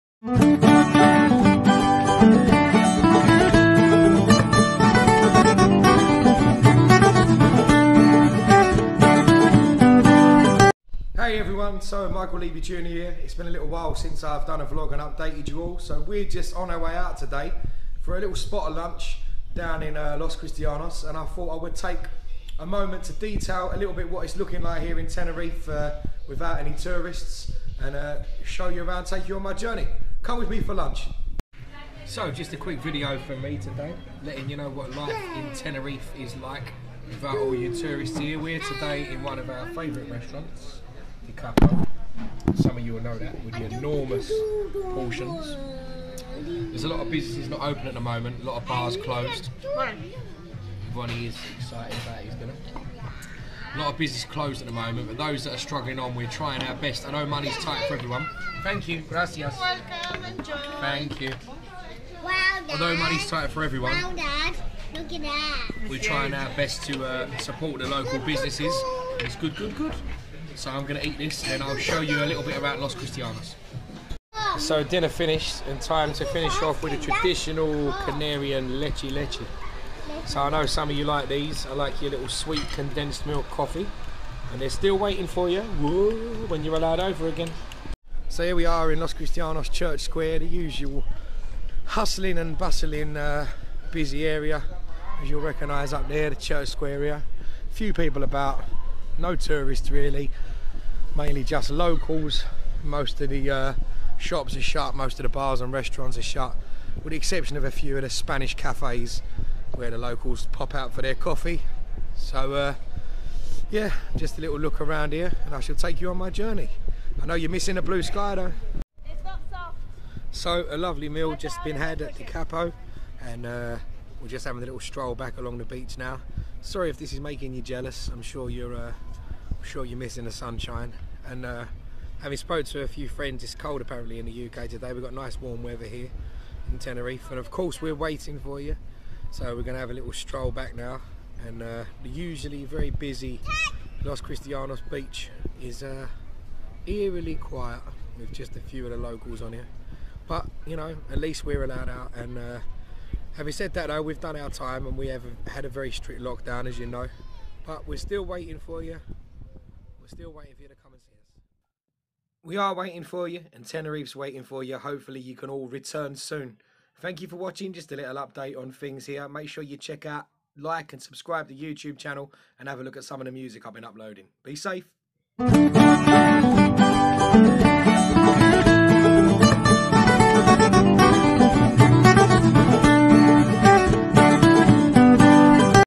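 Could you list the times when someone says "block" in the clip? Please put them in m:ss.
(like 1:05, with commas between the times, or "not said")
not said.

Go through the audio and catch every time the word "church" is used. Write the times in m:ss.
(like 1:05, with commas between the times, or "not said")
1:29, 1:36.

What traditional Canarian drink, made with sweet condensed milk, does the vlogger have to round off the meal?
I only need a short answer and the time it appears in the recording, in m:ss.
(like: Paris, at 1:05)
leche leche, at 1:18.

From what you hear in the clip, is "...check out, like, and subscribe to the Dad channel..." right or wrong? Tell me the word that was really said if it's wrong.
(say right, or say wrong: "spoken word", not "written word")
wrong: "YouTube", not "Dad".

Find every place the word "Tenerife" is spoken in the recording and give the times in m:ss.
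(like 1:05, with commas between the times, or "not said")
0:25, 0:35, 2:16, 2:43.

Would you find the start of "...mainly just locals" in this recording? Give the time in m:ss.
1:41.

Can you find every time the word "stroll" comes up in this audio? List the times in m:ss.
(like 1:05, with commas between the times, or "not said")
2:04, 2:20.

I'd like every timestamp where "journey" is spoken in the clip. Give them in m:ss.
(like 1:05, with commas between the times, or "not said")
0:29, 1:56.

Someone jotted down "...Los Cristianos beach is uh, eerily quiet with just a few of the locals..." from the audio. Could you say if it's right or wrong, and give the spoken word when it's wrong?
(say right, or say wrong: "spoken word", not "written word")
right.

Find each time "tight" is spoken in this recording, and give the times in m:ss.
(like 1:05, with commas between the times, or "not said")
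0:57, 1:03.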